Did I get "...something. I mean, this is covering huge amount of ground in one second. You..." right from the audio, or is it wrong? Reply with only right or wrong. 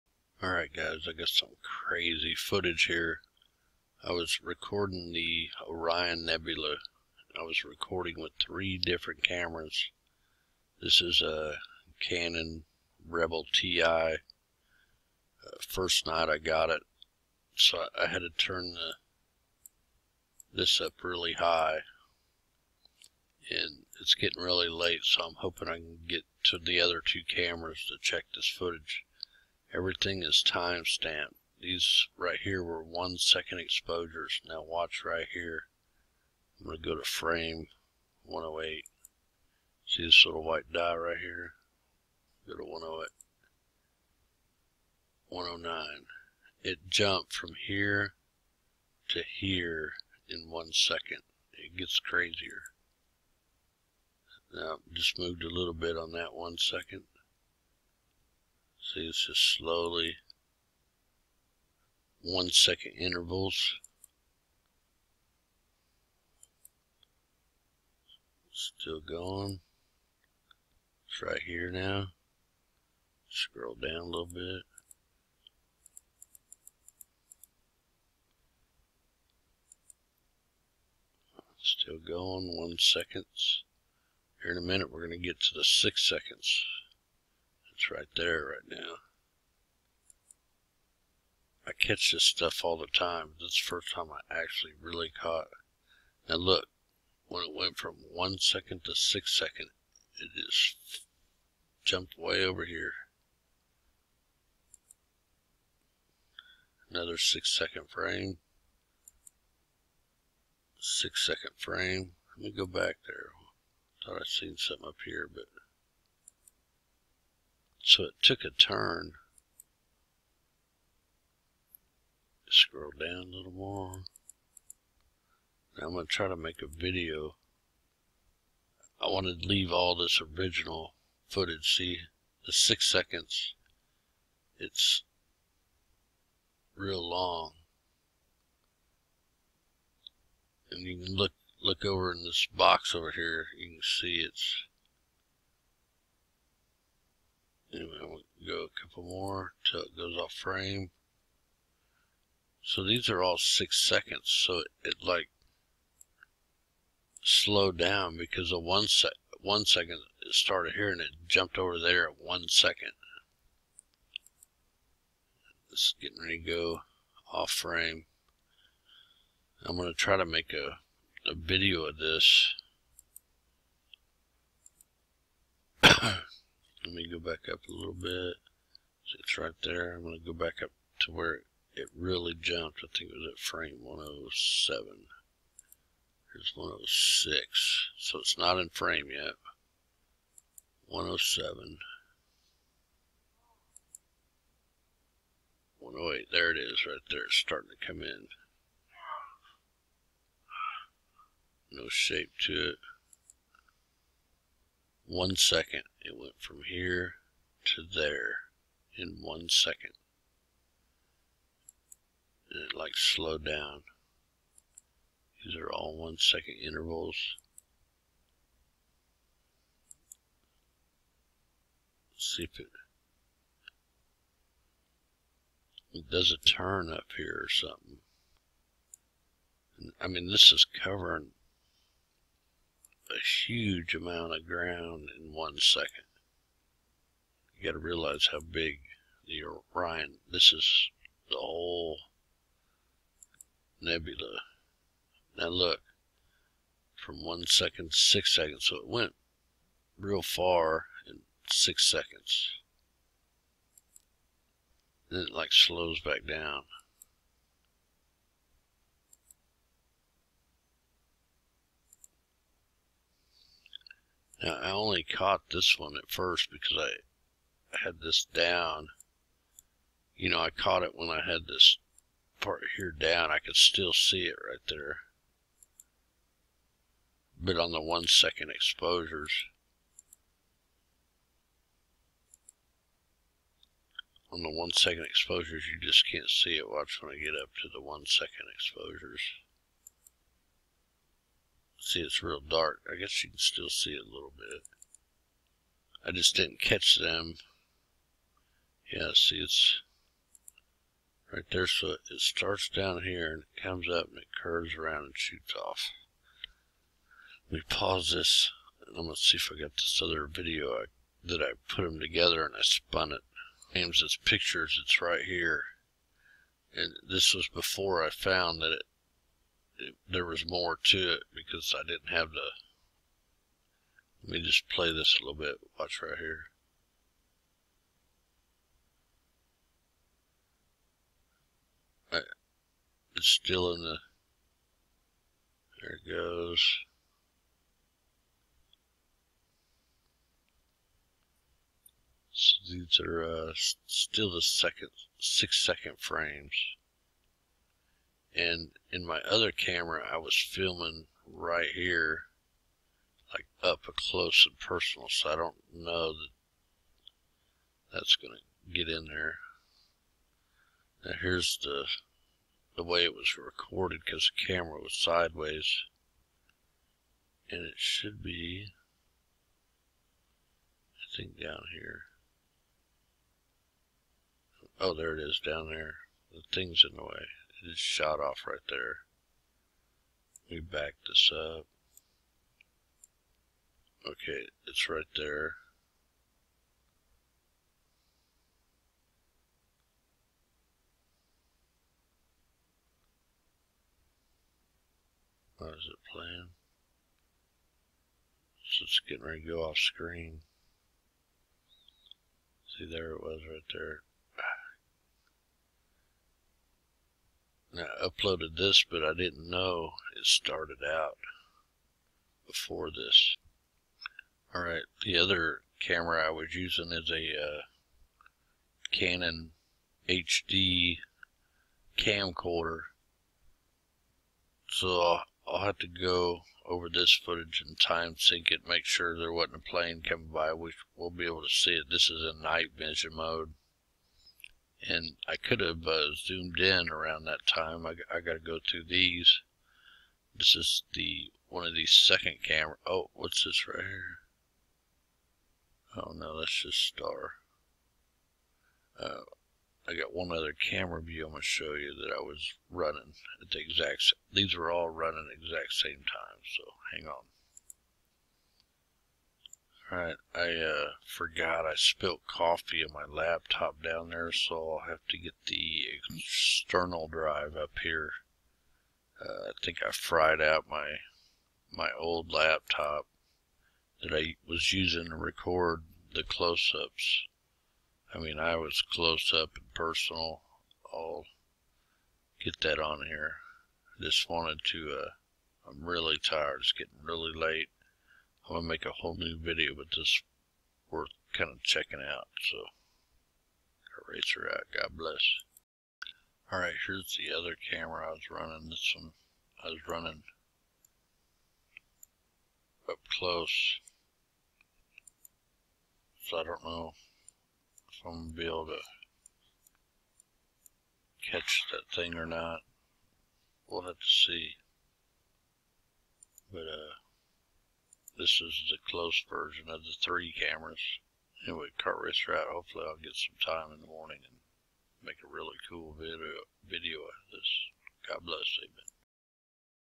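right.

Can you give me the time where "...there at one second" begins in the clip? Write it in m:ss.
2:41.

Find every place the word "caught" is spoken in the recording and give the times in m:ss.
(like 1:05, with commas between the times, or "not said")
1:35, 4:25, 4:30.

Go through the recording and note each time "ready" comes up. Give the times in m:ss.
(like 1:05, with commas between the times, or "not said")
2:46, 6:39.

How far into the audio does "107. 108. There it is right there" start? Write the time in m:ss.
3:10.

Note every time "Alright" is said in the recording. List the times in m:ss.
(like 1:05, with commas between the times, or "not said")
0:00, 7:39.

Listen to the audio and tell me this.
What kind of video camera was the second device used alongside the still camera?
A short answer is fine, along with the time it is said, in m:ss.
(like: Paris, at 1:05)
Canon HD camcorder, at 6:58.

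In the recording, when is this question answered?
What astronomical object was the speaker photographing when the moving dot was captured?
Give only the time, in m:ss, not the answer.
0:05.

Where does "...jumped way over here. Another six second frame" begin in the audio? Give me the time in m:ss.
1:41.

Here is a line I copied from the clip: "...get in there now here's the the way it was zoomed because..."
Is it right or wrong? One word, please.
wrong.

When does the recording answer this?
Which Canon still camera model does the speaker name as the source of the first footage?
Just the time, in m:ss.
0:11.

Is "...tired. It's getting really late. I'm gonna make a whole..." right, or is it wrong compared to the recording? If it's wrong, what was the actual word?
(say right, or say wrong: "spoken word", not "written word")
right.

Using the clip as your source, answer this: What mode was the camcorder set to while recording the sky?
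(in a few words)
night vision mode.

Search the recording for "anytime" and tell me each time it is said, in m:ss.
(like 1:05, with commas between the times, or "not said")
not said.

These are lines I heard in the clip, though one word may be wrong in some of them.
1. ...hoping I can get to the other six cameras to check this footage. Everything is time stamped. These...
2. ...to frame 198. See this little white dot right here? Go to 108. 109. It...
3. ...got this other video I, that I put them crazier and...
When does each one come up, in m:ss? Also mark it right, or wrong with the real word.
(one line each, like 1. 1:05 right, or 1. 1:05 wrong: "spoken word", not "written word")
1. 0:25 wrong: "two", not "six"
2. 0:36 wrong: "108", not "198"
3. 5:09 wrong: "together", not "crazier".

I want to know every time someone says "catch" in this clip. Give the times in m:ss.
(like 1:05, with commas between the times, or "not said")
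1:31, 4:56, 8:31.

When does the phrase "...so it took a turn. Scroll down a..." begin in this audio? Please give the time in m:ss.
1:57.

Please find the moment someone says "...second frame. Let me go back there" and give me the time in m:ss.
1:51.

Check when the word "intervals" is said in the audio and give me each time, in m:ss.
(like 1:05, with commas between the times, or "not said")
1:02, 3:36.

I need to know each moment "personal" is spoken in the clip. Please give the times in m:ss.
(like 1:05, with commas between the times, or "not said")
5:54, 7:59.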